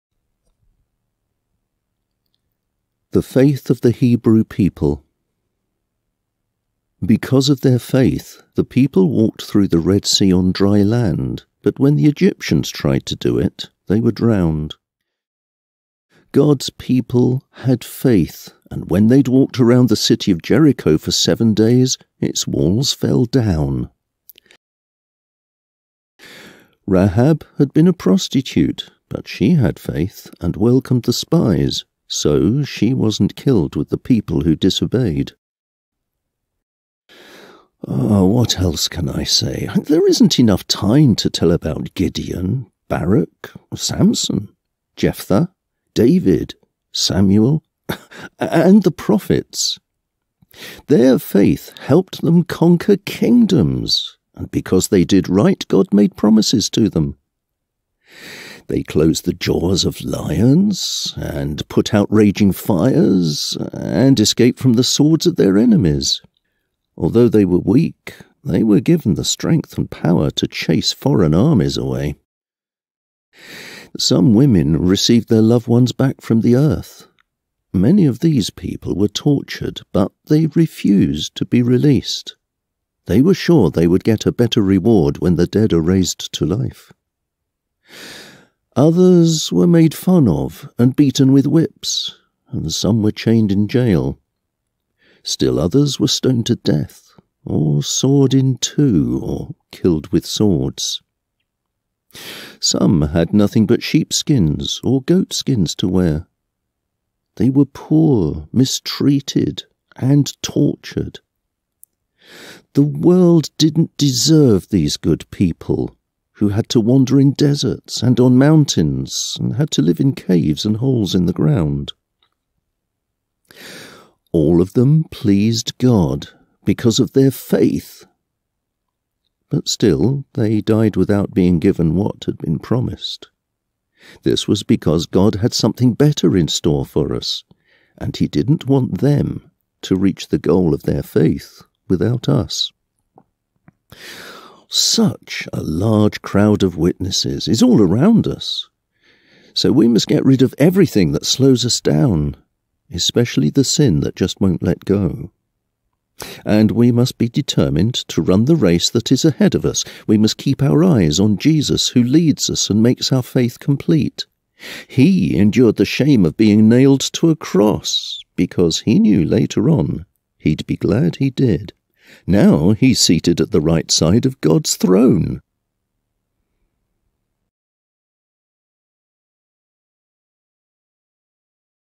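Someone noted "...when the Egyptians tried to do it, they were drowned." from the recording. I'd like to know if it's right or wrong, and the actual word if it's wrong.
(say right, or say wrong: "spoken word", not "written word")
right.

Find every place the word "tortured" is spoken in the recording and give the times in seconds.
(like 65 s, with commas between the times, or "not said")
79 s, 110 s.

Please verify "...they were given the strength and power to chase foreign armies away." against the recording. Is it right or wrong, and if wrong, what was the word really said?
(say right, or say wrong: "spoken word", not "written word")
right.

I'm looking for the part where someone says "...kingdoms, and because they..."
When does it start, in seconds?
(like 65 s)
52 s.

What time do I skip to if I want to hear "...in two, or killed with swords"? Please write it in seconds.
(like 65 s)
98 s.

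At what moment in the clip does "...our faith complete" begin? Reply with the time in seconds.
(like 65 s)
163 s.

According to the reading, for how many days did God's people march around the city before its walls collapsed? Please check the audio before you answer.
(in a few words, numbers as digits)
7.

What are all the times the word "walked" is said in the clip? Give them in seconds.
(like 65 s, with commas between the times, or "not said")
9 s, 19 s.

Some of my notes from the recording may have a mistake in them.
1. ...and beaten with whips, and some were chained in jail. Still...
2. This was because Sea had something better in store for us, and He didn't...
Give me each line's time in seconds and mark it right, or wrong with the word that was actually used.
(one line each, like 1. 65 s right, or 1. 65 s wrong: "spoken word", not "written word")
1. 90 s right
2. 134 s wrong: "God", not "Sea".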